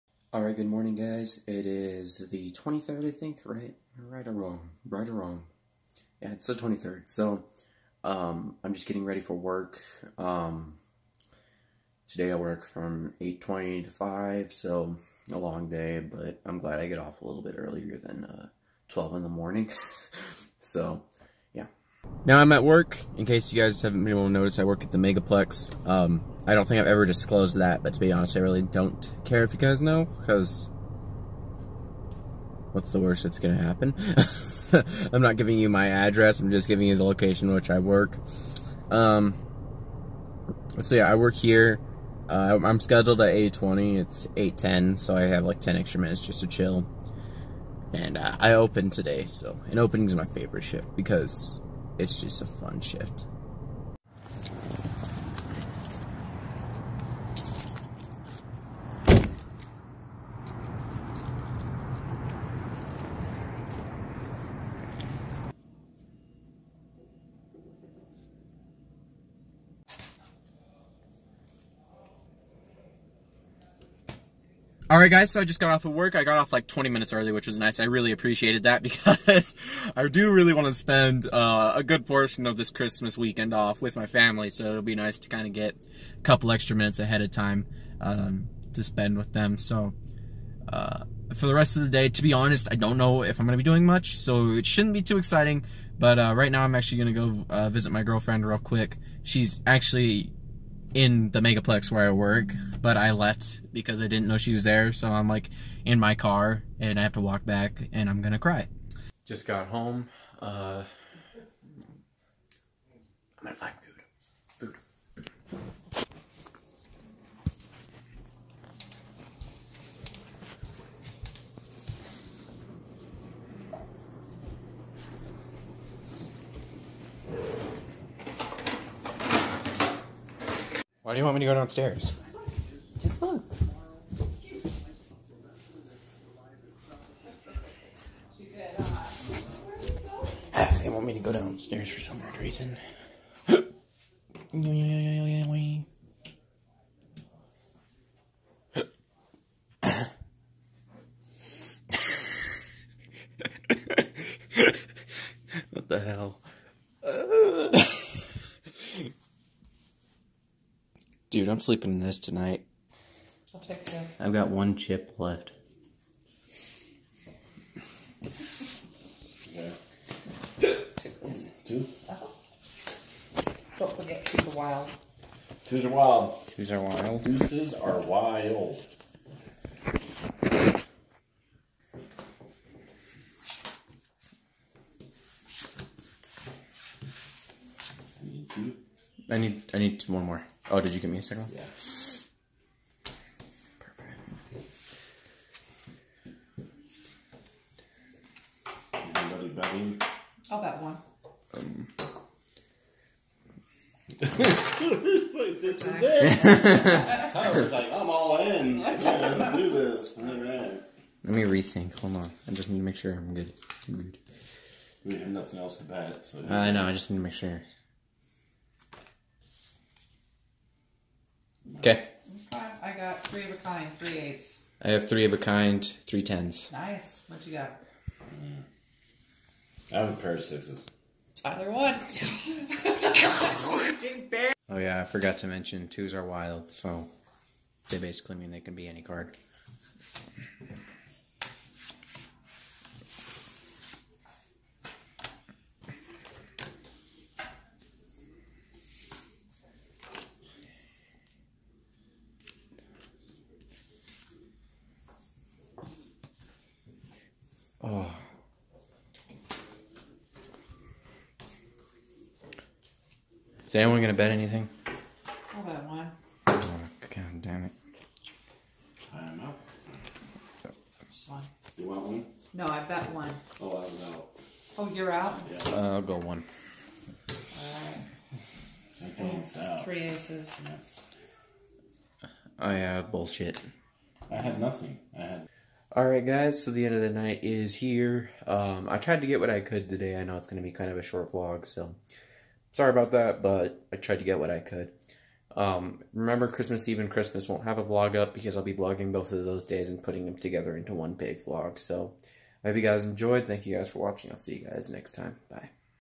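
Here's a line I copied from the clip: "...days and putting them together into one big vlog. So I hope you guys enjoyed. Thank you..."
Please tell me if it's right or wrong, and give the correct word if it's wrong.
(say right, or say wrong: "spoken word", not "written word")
right.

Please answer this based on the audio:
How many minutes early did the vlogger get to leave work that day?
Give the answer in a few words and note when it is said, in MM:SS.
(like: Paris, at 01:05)
20, at 01:16.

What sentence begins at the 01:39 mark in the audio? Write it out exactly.
She's actually in the megaplex where I work, but I left because I didn't know she was there.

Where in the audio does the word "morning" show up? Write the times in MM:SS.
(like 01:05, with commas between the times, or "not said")
00:00, 00:19.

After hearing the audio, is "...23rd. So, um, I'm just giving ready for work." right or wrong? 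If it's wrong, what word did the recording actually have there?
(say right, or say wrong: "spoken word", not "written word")
wrong: "getting", not "giving".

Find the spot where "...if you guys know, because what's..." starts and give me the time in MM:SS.
00:29.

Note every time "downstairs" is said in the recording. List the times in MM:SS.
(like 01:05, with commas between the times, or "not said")
02:11, 02:21.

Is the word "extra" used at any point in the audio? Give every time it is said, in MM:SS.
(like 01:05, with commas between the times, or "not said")
00:45, 01:26.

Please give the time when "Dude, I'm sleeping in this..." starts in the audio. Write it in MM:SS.
02:41.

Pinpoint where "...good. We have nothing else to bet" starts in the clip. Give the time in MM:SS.
03:34.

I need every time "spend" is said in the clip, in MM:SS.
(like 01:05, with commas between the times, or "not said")
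01:20, 01:28.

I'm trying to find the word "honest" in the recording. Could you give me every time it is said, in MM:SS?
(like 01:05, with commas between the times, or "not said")
00:28, 01:32.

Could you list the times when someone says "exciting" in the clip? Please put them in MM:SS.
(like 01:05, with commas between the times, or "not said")
01:35.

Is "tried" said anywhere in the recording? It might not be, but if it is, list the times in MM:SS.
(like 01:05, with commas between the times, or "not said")
04:48, 04:53.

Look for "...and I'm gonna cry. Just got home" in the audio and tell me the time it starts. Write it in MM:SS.
01:47.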